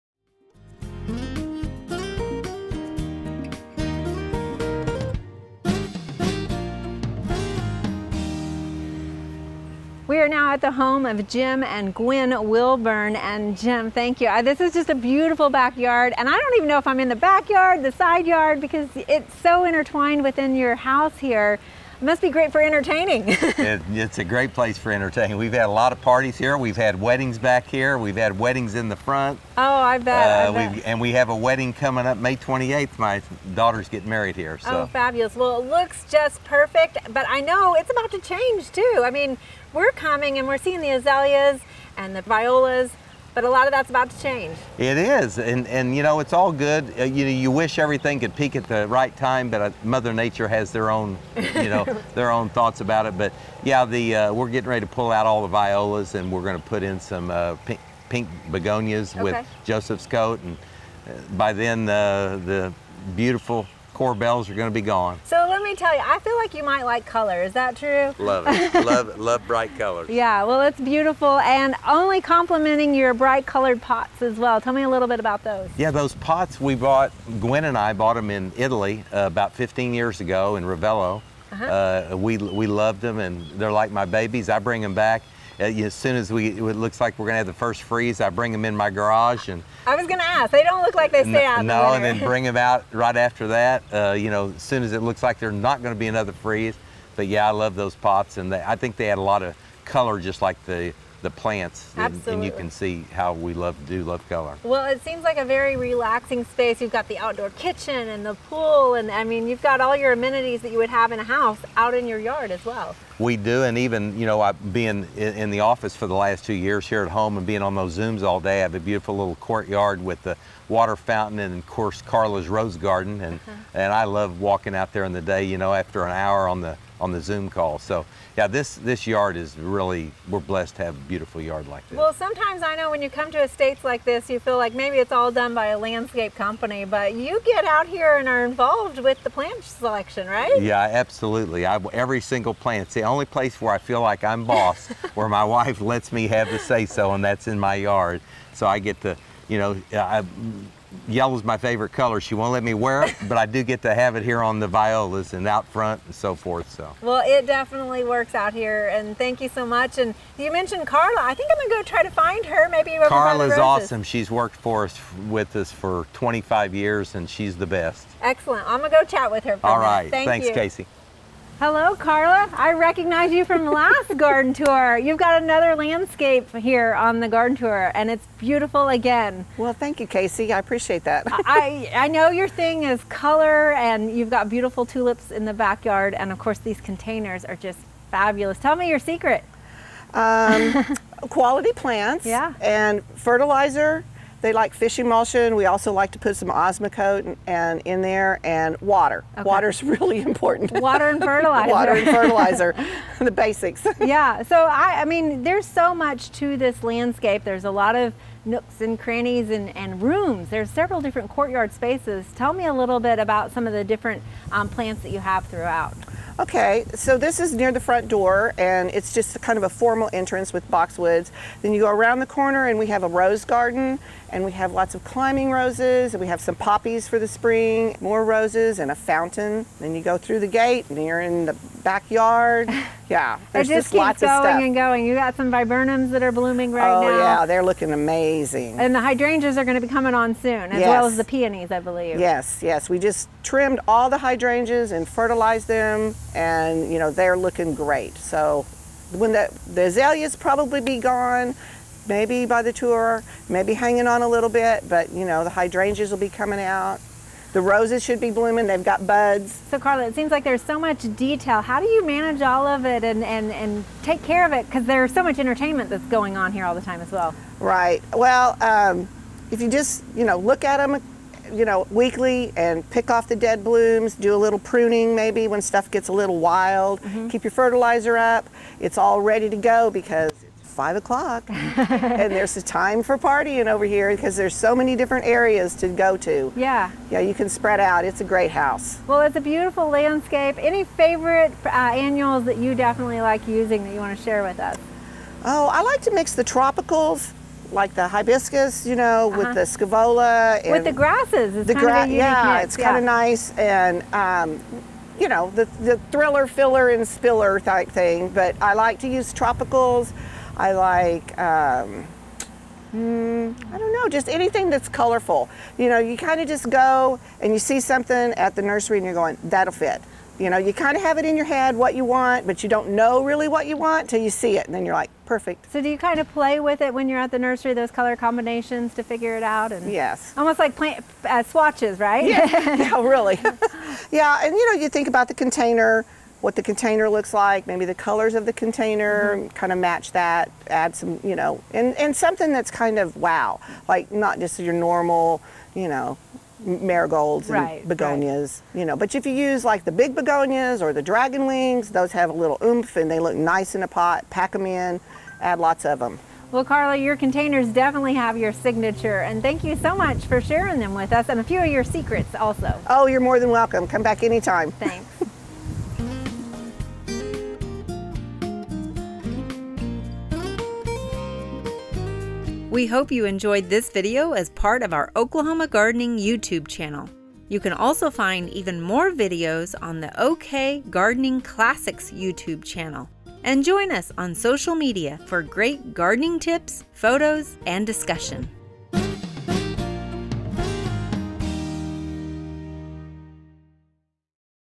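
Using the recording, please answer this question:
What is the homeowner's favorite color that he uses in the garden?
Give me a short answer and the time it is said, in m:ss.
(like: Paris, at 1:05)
Yellow, at 2:31.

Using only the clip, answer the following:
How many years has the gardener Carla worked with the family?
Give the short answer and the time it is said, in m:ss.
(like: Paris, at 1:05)
25 years, at 2:46.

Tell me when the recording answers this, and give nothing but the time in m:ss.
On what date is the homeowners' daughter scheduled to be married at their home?
0:32.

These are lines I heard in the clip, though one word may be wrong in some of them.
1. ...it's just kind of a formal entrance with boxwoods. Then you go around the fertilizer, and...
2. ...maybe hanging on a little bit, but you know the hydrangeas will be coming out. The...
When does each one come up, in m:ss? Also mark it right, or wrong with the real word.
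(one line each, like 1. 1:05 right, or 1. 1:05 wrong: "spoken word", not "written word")
1. 3:38 wrong: "corner", not "fertilizer"
2. 4:13 right.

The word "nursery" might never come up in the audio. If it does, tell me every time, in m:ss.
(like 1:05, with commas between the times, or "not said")
5:18, 5:27.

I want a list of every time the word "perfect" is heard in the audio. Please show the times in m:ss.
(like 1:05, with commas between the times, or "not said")
0:36, 5:25.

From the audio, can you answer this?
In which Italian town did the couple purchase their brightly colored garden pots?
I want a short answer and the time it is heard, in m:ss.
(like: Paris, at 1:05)
Ravello, at 1:20.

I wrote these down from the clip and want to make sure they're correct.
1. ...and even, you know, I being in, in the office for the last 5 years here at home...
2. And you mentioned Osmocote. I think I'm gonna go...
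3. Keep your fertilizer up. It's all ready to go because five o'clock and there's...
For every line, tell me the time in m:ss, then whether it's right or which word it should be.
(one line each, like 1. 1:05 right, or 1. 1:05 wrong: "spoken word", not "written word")
1. 1:53 wrong: "2", not "5"
2. 2:39 wrong: "Carla", not "Osmocote"
3. 4:37 right.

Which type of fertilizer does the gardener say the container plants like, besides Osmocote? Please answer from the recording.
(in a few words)
Fish emulsion.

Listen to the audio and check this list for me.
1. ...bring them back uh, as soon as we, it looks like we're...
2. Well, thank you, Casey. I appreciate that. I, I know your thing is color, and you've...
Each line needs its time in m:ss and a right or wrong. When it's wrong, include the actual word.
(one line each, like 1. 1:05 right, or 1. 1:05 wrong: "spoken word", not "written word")
1. 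1:24 right
2. 2:59 right.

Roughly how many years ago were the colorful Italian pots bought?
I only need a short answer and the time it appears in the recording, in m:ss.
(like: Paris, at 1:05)
15 years, at 1:19.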